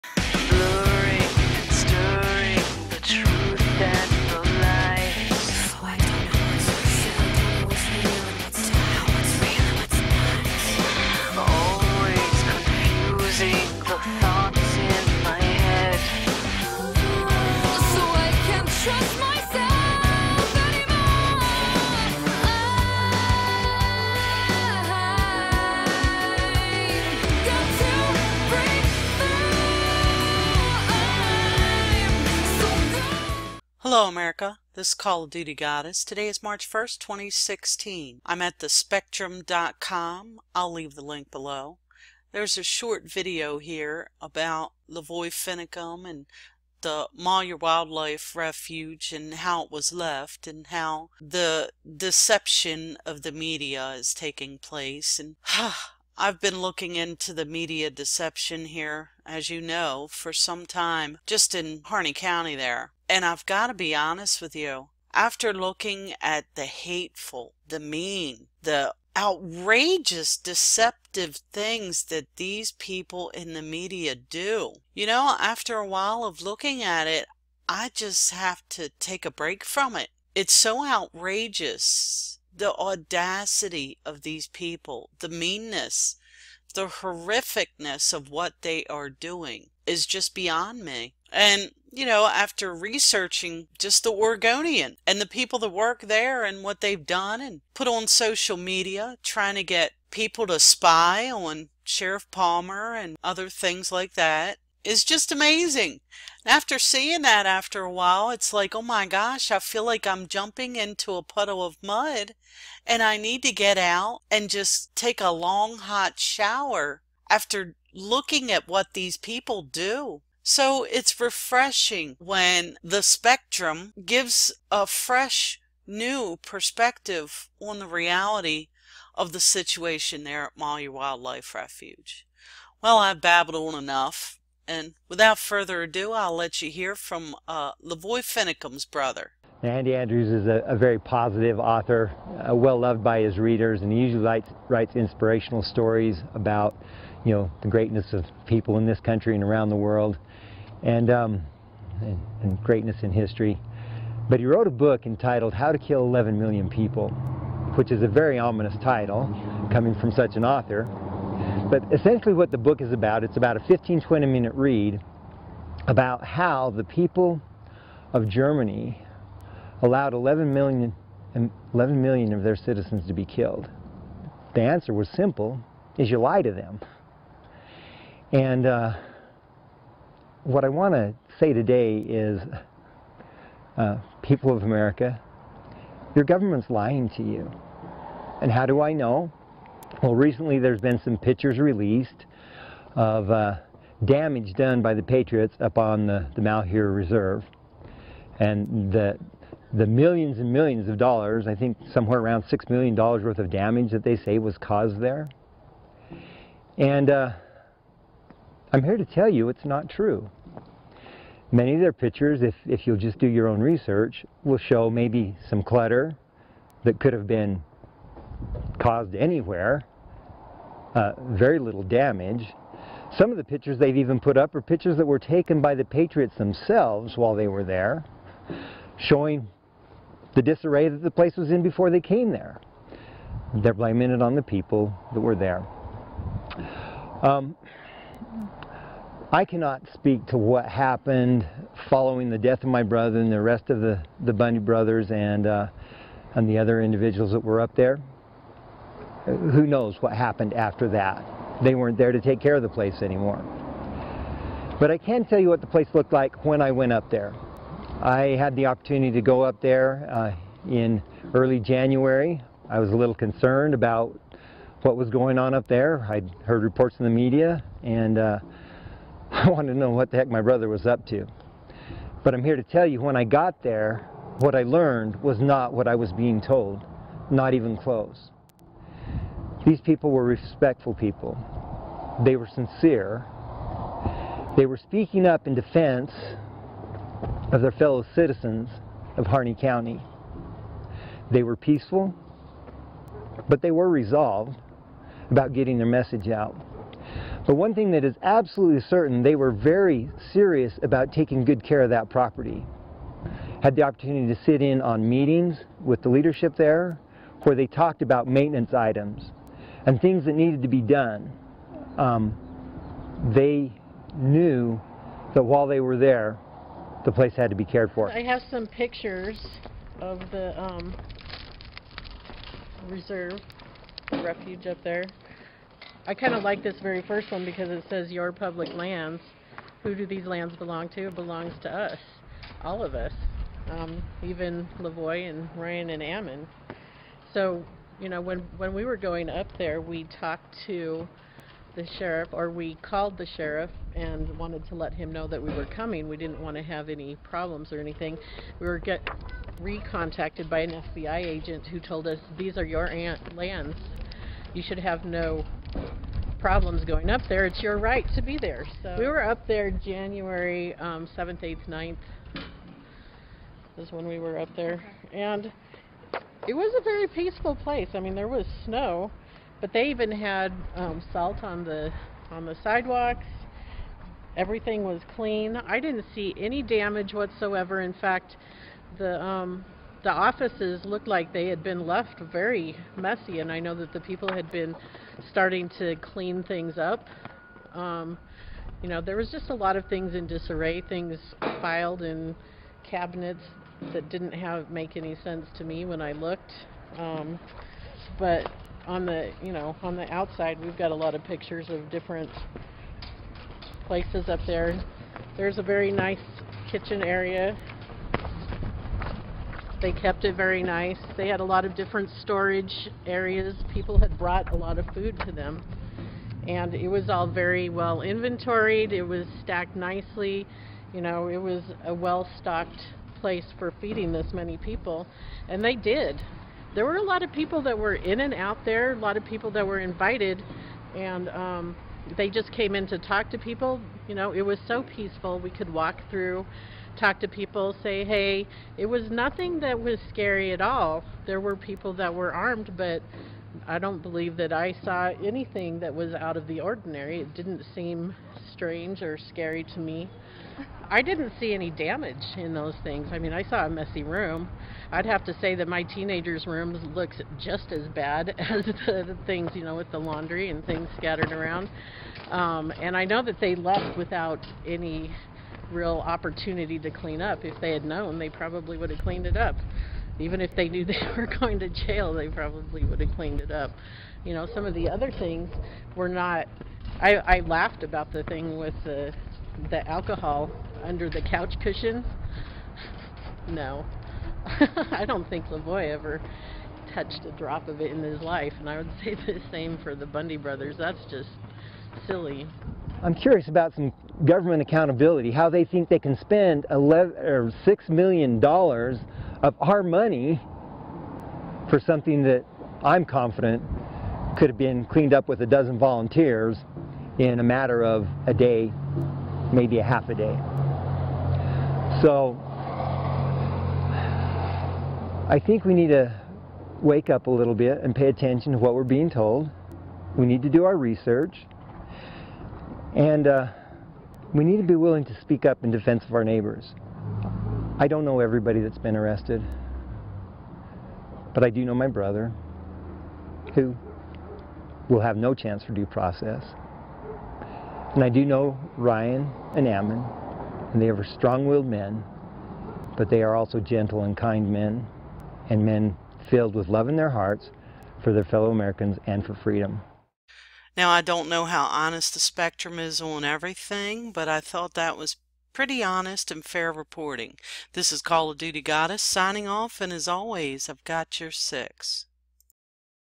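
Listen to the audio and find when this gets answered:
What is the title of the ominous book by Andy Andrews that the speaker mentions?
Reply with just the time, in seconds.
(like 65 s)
155 s.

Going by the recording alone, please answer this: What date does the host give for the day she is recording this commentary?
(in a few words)
March 1st, 2016.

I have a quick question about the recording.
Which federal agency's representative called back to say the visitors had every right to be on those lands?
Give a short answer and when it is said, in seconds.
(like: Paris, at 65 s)
FBI, at 350 s.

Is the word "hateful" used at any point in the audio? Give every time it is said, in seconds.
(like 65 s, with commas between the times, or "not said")
66 s.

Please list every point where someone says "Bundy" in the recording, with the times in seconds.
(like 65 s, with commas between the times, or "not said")
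244 s, 490 s.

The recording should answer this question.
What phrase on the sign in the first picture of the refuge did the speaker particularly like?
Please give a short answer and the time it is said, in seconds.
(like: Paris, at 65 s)
your public lands, at 328 s.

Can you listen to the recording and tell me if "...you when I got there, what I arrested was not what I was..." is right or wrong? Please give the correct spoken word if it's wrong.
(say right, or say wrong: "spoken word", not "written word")
wrong: "learned", not "arrested".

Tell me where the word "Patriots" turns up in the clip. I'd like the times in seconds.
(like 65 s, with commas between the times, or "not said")
195 s, 225 s.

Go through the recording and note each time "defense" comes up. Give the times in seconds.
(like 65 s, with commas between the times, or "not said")
285 s, 525 s.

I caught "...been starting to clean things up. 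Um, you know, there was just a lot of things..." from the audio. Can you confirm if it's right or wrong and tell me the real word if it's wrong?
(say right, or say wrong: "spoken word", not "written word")
right.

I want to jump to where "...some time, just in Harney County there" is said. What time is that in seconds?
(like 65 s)
60 s.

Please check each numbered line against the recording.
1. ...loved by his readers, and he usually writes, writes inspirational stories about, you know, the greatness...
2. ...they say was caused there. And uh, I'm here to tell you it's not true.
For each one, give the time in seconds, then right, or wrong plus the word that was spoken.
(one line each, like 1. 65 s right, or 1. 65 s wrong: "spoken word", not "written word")
1. 142 s right
2. 204 s right.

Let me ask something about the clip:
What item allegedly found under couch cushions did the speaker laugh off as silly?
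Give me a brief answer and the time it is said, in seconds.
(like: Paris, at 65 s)
alcohol, at 479 s.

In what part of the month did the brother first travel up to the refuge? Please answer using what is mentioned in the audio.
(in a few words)
early January.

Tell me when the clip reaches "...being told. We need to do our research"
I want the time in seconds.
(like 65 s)
518 s.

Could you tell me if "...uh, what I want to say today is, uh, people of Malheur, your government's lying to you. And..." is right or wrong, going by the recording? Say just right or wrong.
wrong.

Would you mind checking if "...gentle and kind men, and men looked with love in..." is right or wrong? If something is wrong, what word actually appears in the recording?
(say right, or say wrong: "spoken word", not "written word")
wrong: "filled", not "looked".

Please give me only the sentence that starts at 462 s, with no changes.
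Um, and I know that they left without any real opportunity to clean up.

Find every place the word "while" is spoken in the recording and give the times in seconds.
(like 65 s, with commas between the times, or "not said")
75 s, 107 s, 227 s, 315 s.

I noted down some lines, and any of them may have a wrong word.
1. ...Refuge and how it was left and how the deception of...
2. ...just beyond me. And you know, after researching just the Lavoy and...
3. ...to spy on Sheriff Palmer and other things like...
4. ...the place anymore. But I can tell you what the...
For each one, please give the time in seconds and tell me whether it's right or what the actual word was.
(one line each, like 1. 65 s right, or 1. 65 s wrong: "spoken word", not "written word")
1. 48 s right
2. 90 s wrong: "Oregonian", not "Lavoy"
3. 100 s right
4. 252 s right.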